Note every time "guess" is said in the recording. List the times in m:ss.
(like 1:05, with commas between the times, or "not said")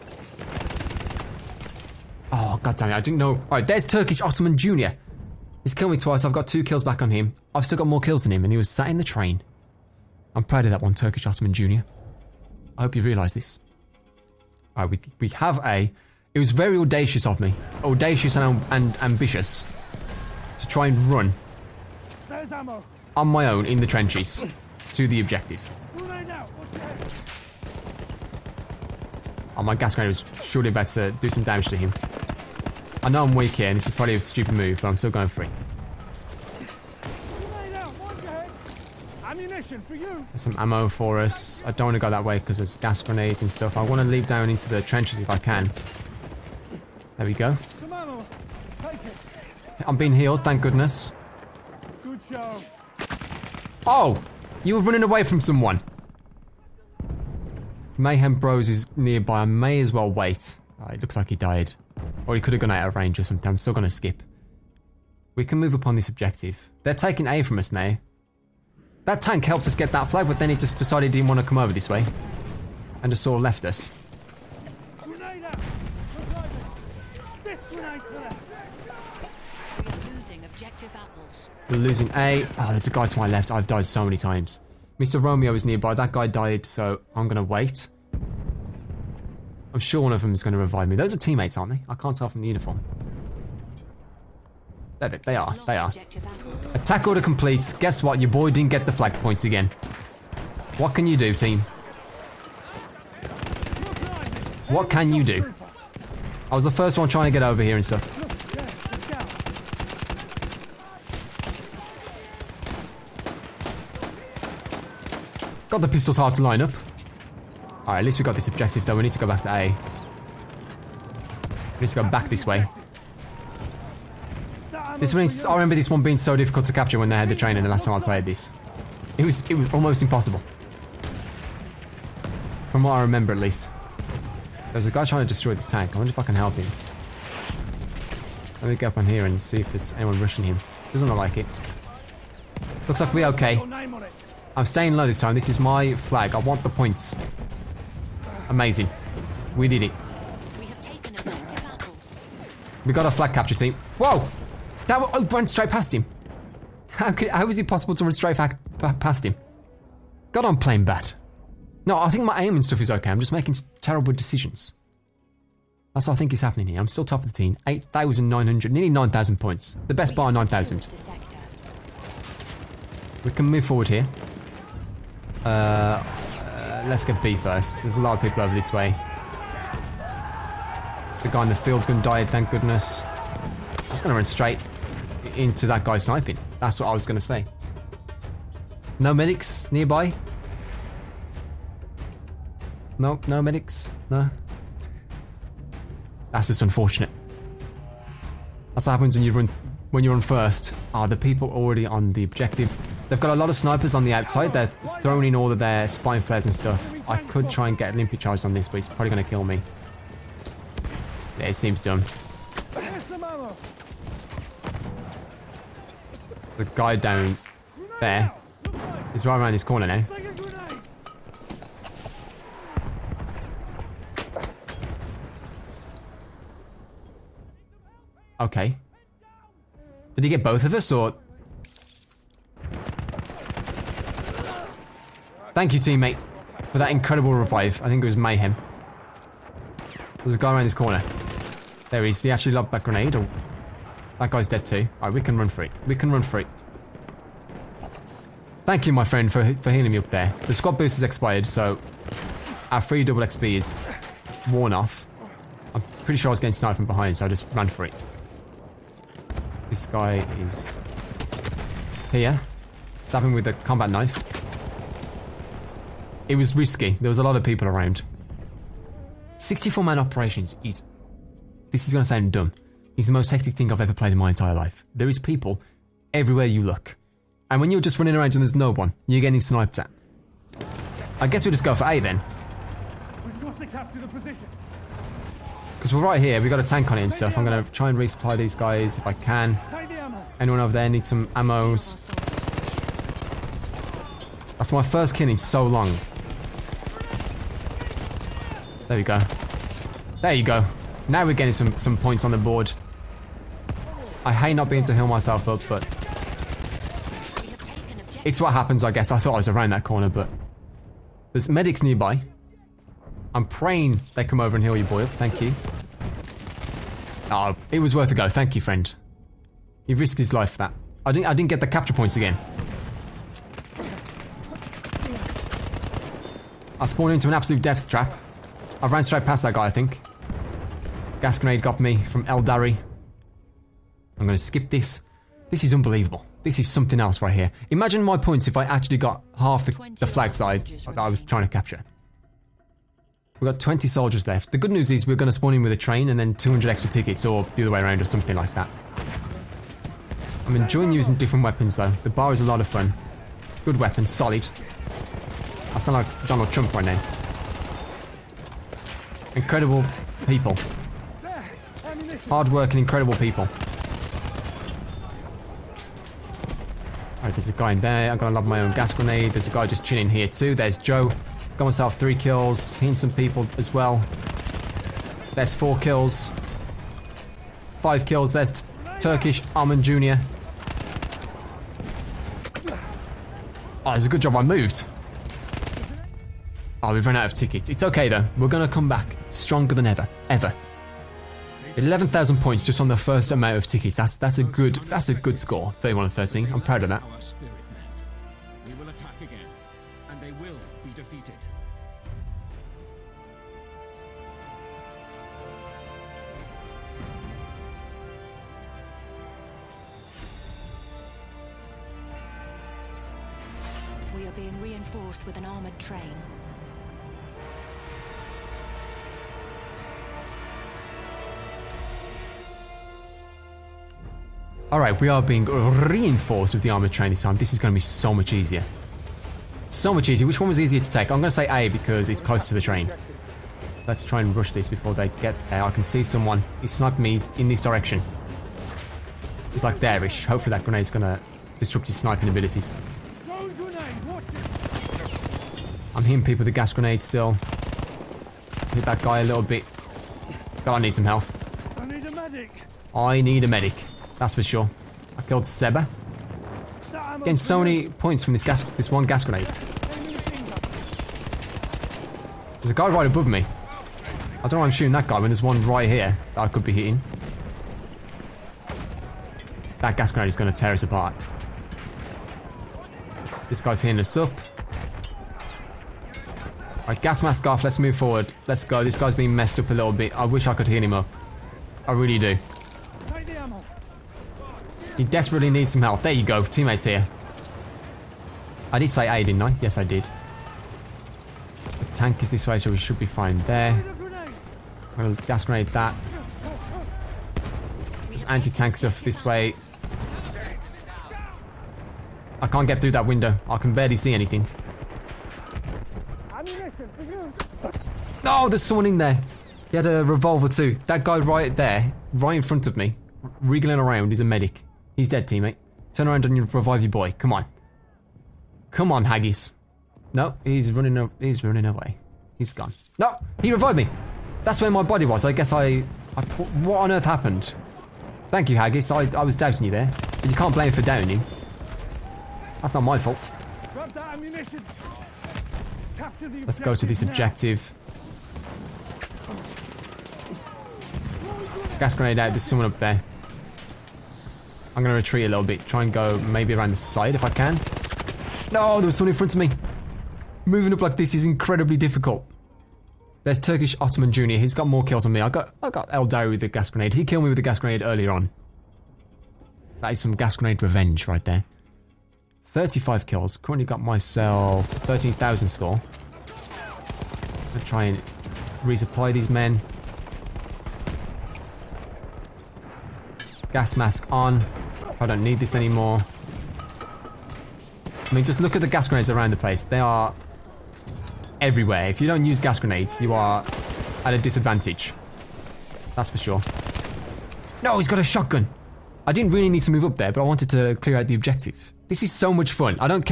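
1:37, 4:41, 5:08, 8:45.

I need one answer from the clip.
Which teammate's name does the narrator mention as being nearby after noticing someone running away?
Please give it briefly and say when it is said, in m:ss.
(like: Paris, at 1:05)
Mayhem Bros, at 0:57.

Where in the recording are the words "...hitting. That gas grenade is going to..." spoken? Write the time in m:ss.
7:46.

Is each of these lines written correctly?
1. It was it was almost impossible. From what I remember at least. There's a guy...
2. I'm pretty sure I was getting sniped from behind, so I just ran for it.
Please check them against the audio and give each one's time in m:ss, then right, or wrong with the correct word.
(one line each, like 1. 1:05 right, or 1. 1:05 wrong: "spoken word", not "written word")
1. 2:09 right
2. 4:15 right.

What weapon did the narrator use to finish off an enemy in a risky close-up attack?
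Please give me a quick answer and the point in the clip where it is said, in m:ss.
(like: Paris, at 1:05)
Combat knife, at 4:23.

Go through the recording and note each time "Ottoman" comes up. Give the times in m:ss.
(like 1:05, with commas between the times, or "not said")
0:04, 0:11, 6:19, 9:13.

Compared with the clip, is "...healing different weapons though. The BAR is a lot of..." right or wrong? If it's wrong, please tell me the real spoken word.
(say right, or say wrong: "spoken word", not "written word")
wrong: "using", not "healing".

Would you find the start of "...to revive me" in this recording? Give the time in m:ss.
1:30.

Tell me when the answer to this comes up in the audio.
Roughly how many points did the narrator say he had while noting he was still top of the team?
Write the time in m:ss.
2:47.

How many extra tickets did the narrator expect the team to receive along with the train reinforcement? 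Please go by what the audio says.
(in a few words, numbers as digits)
200.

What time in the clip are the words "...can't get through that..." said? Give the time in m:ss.
8:22.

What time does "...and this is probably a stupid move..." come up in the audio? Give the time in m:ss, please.
0:33.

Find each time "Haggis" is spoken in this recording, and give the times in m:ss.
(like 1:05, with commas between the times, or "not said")
8:39, 8:48.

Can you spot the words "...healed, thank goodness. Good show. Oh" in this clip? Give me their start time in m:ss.
0:50.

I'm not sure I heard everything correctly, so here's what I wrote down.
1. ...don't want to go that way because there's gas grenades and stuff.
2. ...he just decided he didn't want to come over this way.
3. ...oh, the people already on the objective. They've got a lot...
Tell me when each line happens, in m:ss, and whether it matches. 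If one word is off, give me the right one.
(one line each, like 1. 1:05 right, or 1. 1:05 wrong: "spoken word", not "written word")
1. 0:41 right
2. 1:10 right
3. 3:21 right.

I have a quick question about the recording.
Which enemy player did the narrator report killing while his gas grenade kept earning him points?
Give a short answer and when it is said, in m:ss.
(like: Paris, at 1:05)
Seba, at 7:35.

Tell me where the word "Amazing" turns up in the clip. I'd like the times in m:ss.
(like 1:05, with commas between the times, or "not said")
2:28.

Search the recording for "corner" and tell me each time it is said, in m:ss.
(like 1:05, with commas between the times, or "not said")
3:39, 4:00, 5:09.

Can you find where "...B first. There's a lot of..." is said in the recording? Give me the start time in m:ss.
2:57.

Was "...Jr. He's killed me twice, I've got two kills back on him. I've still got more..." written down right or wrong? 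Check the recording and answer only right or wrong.
right.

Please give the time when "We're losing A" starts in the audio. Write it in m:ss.
1:21.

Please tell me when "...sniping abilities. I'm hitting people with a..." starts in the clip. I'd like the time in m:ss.
7:21.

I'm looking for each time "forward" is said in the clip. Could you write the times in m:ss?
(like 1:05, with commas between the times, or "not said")
2:53, 7:57.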